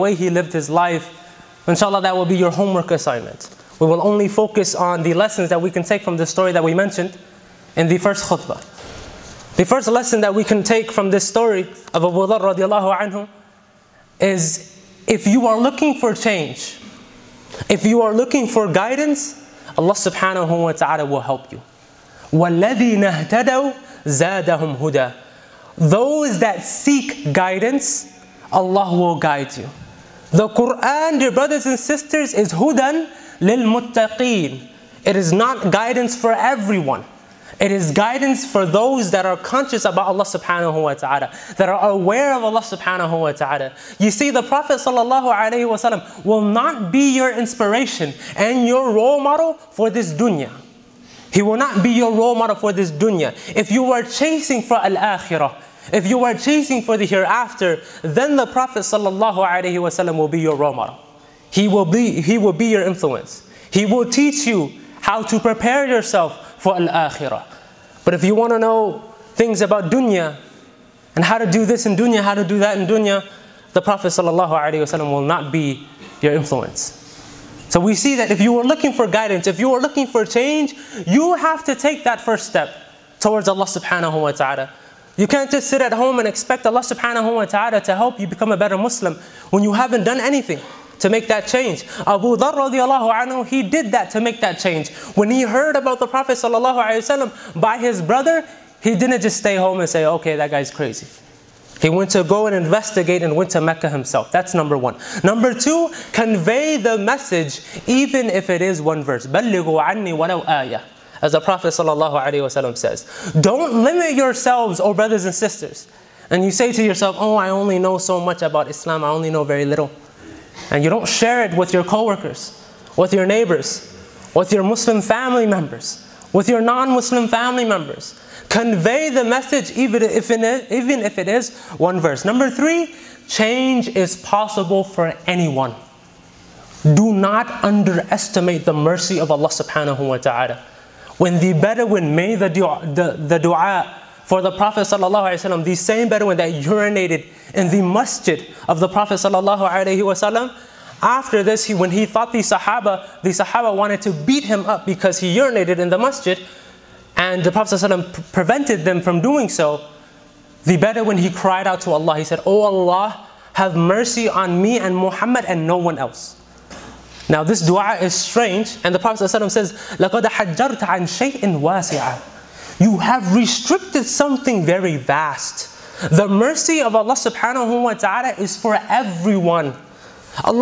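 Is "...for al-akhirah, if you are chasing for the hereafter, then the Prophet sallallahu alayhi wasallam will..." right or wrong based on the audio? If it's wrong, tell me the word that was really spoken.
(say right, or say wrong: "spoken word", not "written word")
right.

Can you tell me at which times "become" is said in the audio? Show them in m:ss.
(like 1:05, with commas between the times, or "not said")
1:28.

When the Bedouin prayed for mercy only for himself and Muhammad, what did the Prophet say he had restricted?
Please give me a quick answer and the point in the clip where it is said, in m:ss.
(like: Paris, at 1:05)
something very vast, at 2:54.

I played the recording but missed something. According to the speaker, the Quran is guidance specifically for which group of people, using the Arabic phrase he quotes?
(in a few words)
lil muttaqeen.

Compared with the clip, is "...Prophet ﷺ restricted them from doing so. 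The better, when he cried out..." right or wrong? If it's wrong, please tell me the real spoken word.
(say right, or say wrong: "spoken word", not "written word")
wrong: "prevented", not "restricted".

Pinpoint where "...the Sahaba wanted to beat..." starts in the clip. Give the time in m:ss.
2:33.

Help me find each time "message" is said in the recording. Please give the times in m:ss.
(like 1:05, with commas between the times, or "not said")
1:46, 2:09.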